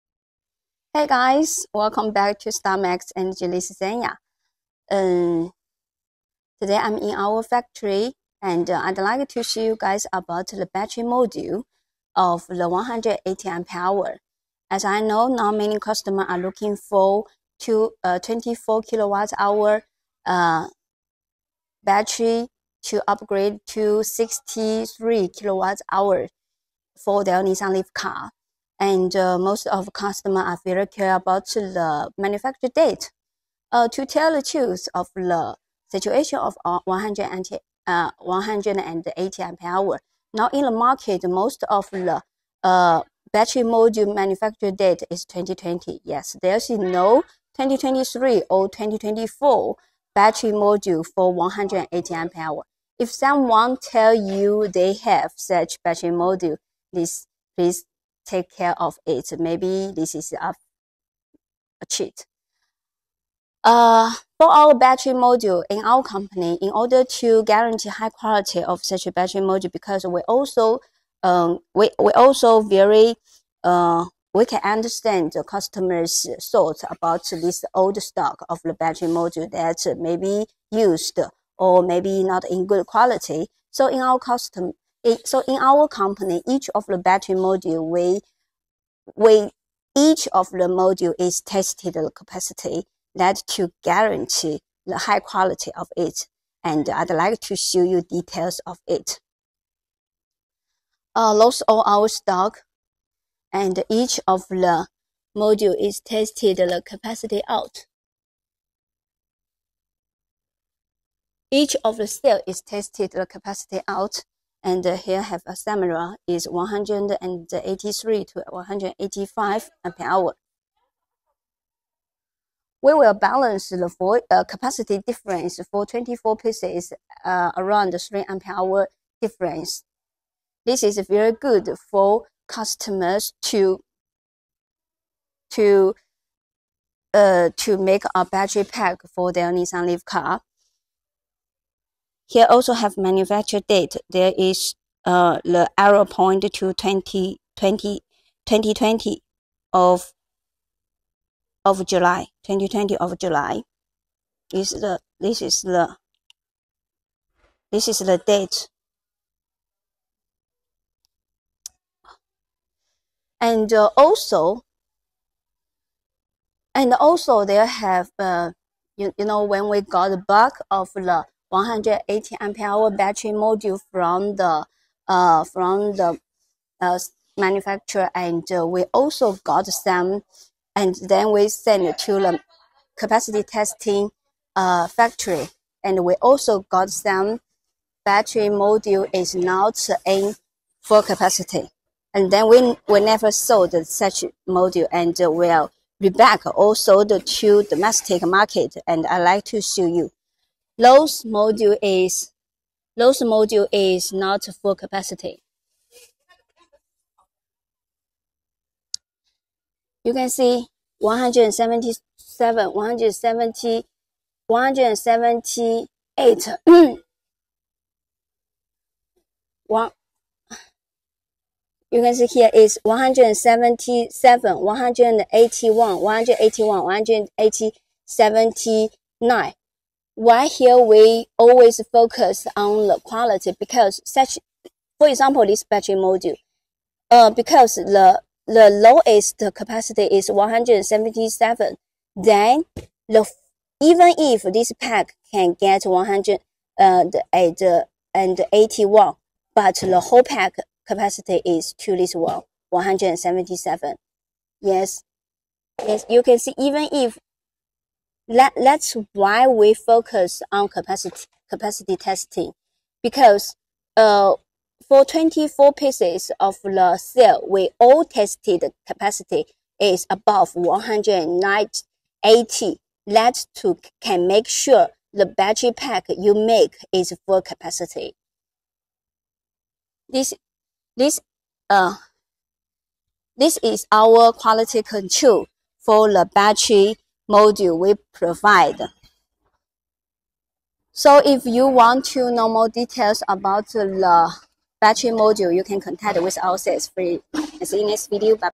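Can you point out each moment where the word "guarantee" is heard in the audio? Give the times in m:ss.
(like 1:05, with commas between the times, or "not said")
1:07, 1:33.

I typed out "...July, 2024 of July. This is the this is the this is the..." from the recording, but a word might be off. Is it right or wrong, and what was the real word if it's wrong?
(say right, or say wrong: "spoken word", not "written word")
wrong: "2020", not "2024".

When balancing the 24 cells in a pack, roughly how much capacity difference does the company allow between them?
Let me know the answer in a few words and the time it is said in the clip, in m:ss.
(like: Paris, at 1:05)
around 3 ampere hour, at 2:07.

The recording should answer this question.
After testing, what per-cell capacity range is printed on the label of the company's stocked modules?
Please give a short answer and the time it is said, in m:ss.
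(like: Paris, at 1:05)
183 to 185, at 1:56.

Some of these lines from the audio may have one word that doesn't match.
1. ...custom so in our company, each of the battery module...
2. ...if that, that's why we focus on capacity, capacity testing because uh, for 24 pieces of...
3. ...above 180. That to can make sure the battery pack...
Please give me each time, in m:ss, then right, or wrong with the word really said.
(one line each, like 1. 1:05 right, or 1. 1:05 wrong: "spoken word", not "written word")
1. 1:24 right
2. 4:16 right
3. 4:30 right.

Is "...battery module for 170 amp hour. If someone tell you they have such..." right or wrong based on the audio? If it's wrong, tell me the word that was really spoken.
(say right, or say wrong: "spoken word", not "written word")
wrong: "180", not "170".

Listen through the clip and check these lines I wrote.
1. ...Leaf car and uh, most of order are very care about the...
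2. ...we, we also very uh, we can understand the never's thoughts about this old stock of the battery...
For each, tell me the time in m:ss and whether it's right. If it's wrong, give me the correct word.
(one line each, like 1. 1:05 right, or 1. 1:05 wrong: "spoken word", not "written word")
1. 0:27 wrong: "customer", not "order"
2. 1:11 wrong: "customer", not "never".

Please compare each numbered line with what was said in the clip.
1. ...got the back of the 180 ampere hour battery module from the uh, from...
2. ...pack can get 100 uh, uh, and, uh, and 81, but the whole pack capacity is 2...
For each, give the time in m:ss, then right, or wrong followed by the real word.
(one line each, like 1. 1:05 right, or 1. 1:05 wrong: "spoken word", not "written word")
1. 2:49 right
2. 4:04 right.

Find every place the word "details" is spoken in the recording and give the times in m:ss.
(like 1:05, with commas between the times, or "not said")
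1:38, 4:52.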